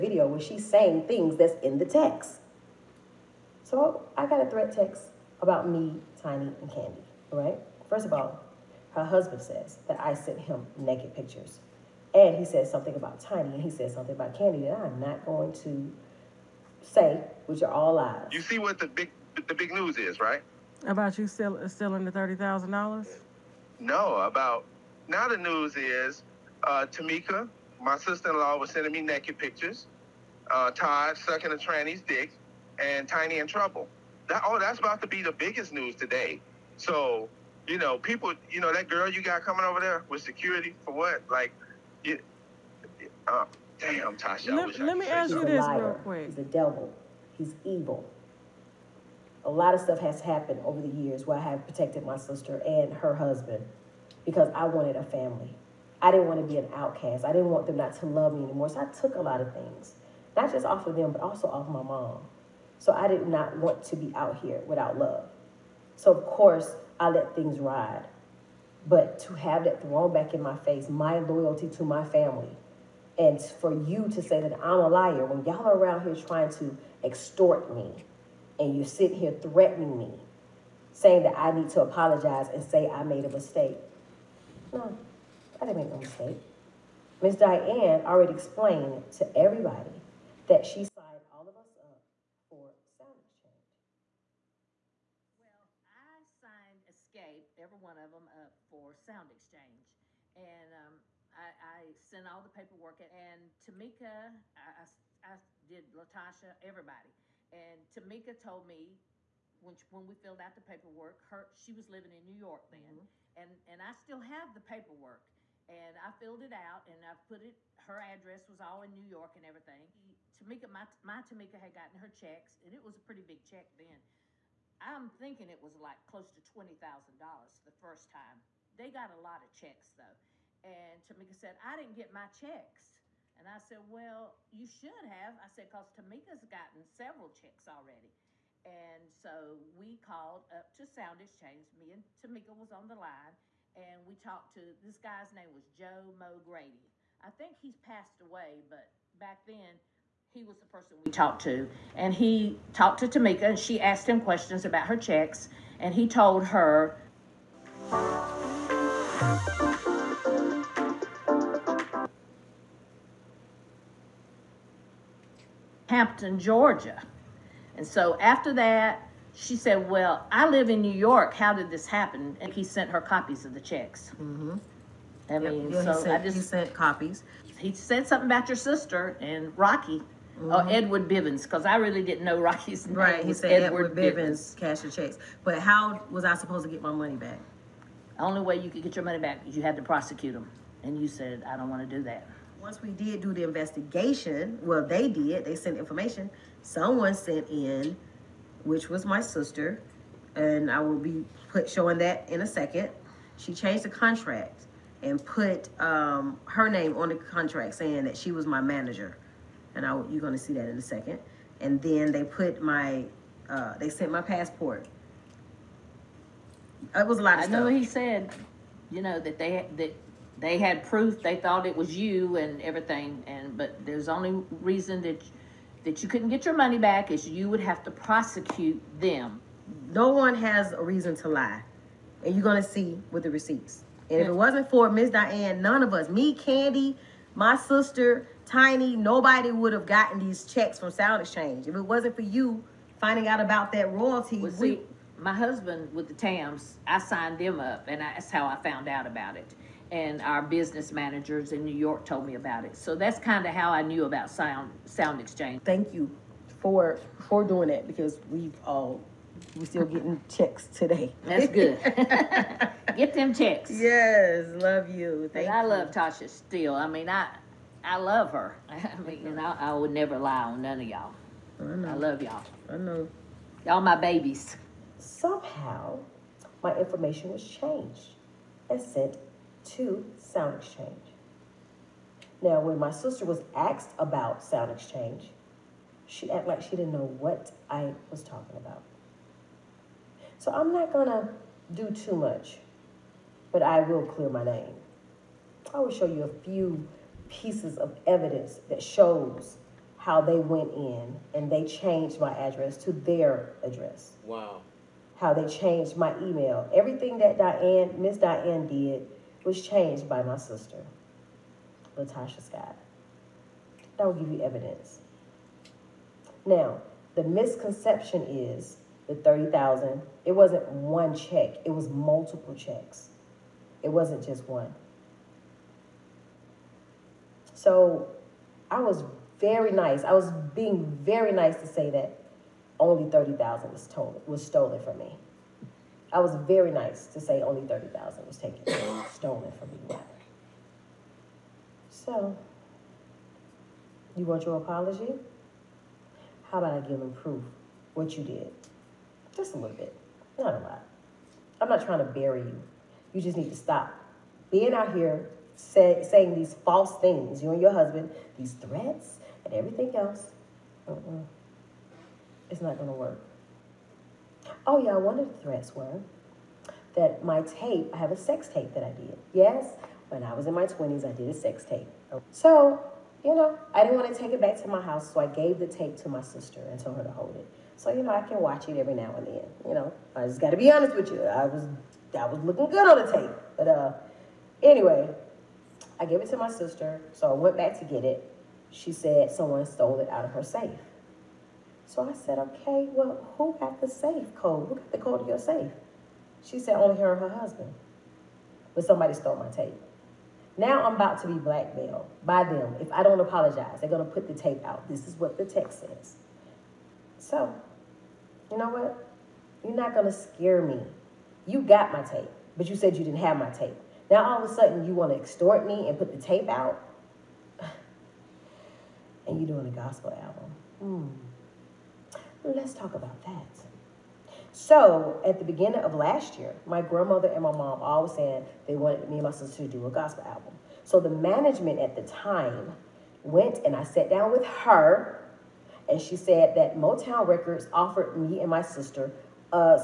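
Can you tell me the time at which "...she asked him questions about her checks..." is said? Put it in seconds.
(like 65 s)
153 s.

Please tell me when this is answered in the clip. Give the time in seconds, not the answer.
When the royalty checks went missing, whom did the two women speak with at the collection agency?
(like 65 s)
145 s.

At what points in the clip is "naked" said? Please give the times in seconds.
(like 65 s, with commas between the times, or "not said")
10 s, 29 s.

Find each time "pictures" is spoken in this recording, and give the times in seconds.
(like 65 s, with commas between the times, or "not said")
11 s, 29 s.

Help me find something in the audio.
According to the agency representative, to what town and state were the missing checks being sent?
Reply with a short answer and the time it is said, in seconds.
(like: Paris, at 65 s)
Hampton, Georgia, at 165 s.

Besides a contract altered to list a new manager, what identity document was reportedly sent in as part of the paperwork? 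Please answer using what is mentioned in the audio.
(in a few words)
Passport.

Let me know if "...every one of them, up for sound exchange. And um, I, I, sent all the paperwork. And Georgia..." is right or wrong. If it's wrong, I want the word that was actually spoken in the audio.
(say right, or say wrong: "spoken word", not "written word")
wrong: "Tamika", not "Georgia".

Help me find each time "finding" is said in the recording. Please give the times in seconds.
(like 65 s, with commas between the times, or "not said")
243 s.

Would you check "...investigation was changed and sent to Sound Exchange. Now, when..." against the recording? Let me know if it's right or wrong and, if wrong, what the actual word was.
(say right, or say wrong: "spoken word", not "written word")
wrong: "information", not "investigation".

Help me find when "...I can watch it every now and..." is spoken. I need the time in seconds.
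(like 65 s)
378 s.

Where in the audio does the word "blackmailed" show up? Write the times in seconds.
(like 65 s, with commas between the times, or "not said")
401 s.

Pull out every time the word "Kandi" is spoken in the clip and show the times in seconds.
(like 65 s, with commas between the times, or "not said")
6 s, 14 s, 236 s.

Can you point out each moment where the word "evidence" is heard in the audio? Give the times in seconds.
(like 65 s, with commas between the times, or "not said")
298 s, 314 s.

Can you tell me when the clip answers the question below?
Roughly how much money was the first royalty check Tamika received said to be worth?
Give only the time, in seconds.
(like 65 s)
126 s.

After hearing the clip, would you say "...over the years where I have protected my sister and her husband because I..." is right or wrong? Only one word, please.
right.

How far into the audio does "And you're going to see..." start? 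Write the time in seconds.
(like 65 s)
232 s.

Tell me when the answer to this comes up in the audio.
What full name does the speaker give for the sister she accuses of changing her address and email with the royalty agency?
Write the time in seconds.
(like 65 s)
311 s.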